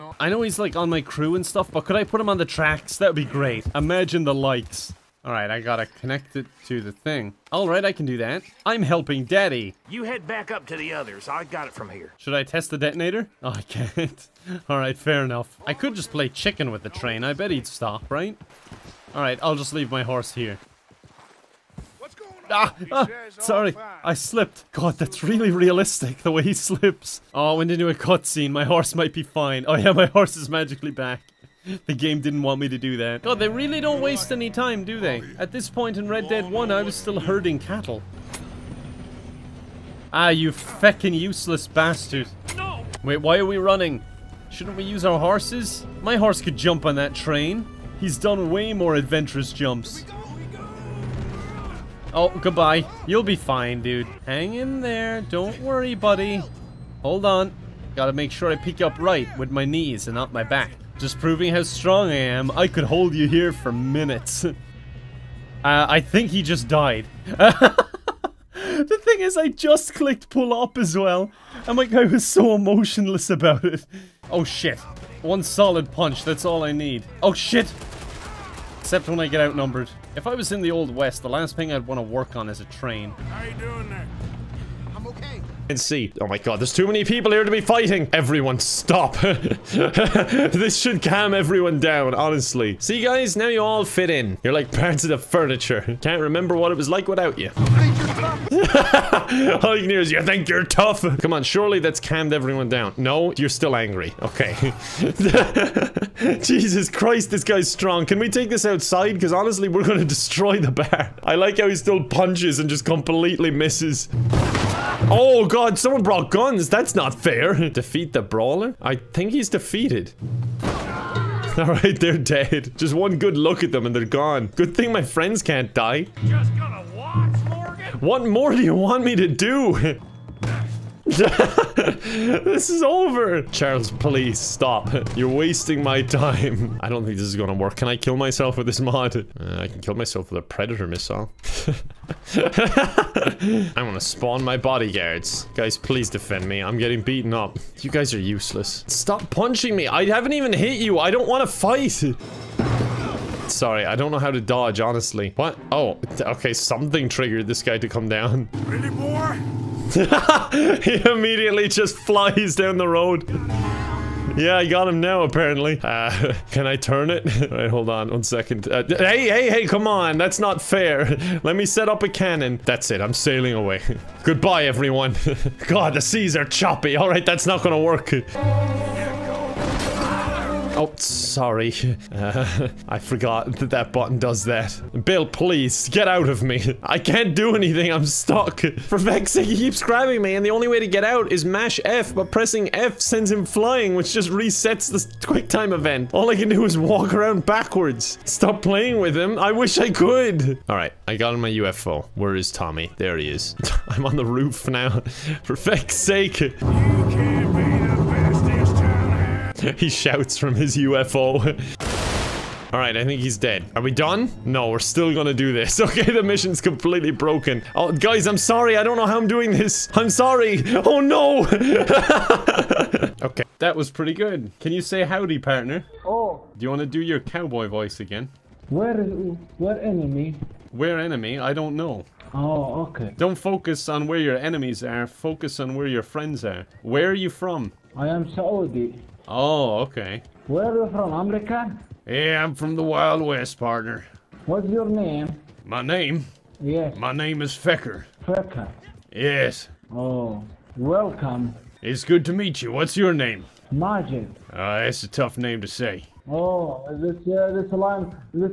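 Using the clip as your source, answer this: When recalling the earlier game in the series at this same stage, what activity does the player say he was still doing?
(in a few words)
herding cattle.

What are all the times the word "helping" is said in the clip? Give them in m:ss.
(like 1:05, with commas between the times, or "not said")
0:08.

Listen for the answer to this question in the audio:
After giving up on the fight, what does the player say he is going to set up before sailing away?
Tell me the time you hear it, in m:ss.
2:52.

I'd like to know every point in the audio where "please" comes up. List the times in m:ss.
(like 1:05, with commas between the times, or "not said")
2:13, 2:25, 3:05.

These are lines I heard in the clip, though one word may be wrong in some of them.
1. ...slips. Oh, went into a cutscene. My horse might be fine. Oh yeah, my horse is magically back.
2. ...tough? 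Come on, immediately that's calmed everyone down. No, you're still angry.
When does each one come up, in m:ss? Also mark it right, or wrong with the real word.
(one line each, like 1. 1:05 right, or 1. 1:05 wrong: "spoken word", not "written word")
1. 0:26 right
2. 1:40 wrong: "surely", not "immediately".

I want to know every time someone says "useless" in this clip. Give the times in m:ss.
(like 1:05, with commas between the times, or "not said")
0:41, 2:28.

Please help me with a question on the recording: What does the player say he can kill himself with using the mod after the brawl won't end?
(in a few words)
a predator missile.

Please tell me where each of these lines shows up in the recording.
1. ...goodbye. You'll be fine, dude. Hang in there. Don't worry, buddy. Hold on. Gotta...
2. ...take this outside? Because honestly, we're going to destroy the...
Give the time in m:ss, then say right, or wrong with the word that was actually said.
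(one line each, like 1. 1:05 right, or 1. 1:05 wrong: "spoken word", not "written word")
1. 0:52 right
2. 1:48 right.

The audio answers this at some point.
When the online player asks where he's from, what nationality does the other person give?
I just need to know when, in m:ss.
3:58.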